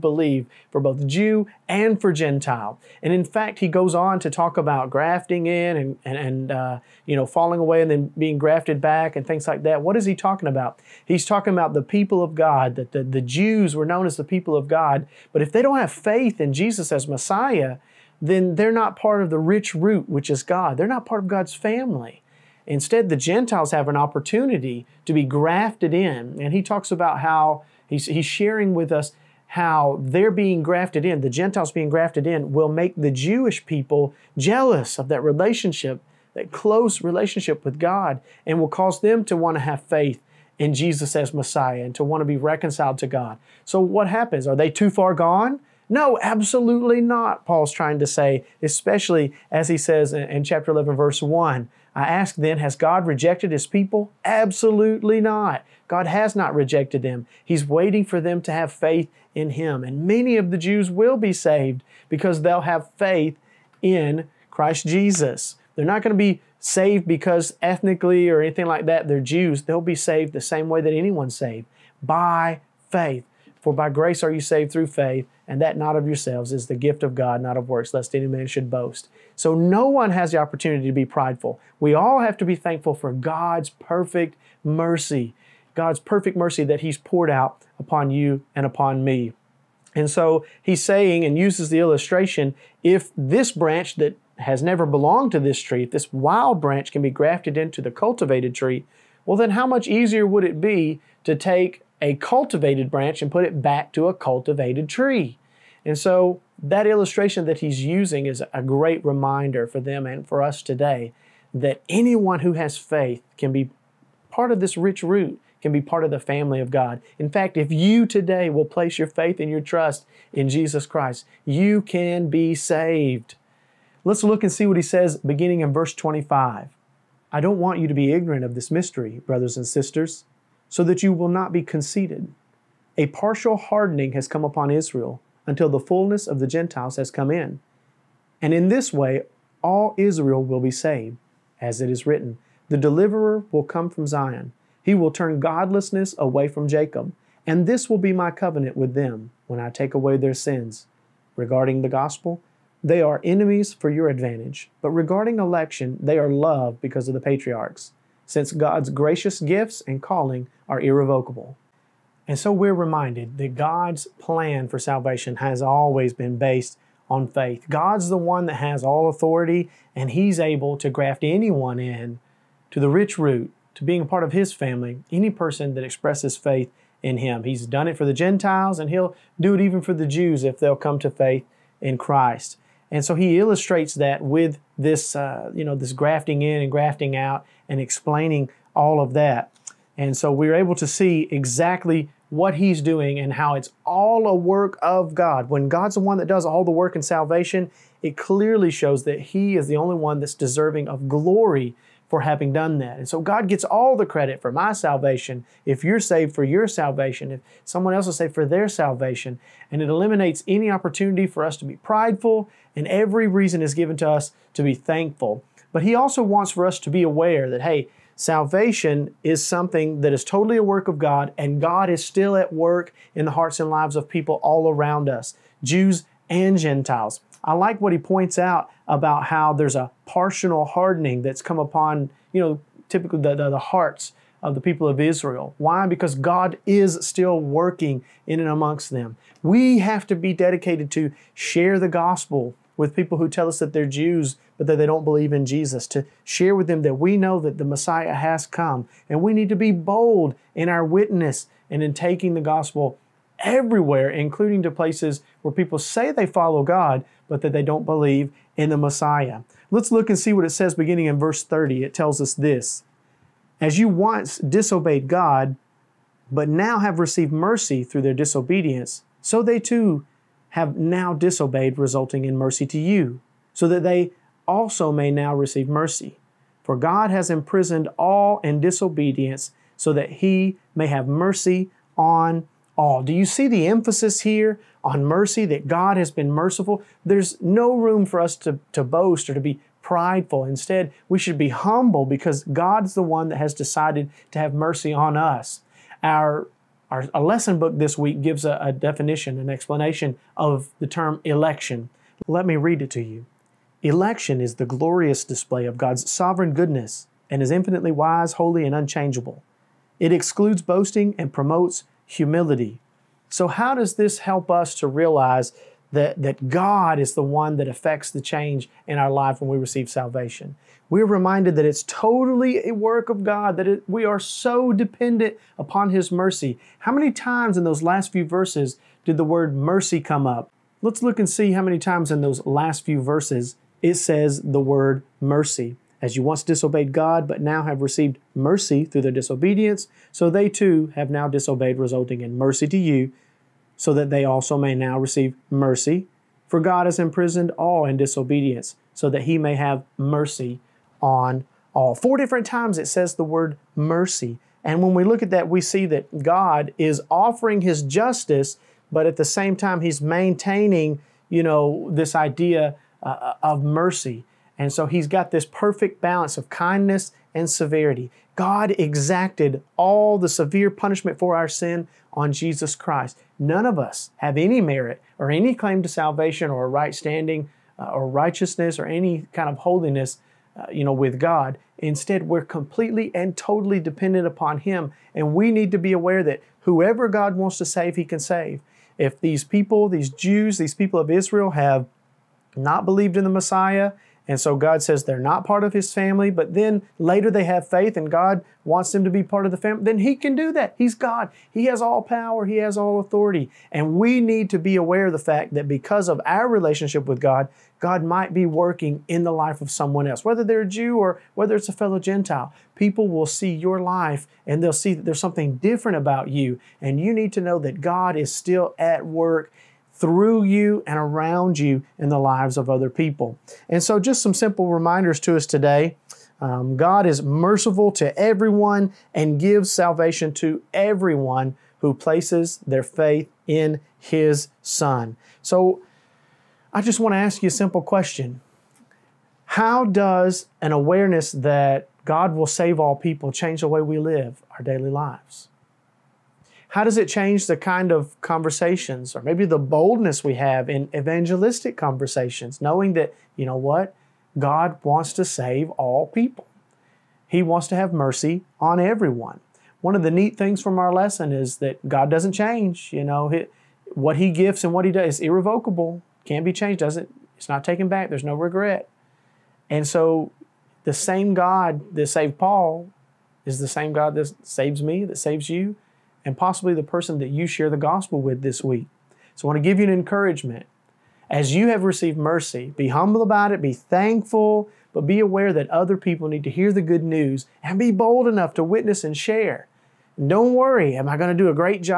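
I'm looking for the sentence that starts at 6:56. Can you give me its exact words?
And you need to know that God is still at work through you and around you in the lives of other people.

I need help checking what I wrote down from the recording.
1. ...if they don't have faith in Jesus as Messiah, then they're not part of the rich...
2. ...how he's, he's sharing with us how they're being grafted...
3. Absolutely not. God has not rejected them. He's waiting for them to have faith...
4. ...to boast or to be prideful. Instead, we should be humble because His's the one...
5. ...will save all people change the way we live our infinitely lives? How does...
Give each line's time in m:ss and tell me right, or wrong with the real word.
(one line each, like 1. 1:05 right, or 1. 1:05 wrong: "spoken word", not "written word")
1. 0:15 right
2. 0:27 right
3. 0:54 right
4. 4:48 wrong: "God", not "His"
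5. 7:22 wrong: "daily", not "infinitely".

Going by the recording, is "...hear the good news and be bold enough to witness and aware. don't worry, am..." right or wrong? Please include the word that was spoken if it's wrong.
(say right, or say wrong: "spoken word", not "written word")
wrong: "share", not "aware".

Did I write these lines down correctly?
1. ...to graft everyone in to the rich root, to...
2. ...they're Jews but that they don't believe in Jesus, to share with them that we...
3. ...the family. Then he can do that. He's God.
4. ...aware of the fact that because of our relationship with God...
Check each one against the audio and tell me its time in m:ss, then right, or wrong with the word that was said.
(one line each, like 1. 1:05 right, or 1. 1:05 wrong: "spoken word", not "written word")
1. 2:50 wrong: "anyone", not "everyone"
2. 4:03 right
3. 6:39 right
4. 6:44 right.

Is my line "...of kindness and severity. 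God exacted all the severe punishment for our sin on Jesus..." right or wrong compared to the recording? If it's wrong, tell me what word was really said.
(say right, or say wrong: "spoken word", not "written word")
right.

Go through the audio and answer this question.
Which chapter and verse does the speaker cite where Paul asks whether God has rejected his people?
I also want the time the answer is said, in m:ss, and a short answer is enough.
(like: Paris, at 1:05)
Chapter 11, verse 1, at 0:50.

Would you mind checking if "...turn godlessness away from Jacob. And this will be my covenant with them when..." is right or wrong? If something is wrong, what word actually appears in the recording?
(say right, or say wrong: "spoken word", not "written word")
right.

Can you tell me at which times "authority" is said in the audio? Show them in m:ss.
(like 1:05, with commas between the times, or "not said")
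2:49, 6:42.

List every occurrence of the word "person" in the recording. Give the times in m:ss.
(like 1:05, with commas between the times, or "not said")
2:55, 7:56.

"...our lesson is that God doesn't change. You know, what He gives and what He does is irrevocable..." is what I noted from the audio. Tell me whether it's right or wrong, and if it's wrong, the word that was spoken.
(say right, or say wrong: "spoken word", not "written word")
right.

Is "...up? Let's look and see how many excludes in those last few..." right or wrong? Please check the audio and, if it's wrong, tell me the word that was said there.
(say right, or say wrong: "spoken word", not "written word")
wrong: "times", not "excludes".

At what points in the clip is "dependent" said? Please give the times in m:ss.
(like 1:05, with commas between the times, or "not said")
5:24, 6:23.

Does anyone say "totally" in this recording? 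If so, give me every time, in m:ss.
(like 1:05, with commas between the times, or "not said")
3:40, 5:21, 6:23.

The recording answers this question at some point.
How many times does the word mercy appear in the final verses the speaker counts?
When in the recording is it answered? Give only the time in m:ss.
5:51.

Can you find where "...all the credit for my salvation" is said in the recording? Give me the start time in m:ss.
3:23.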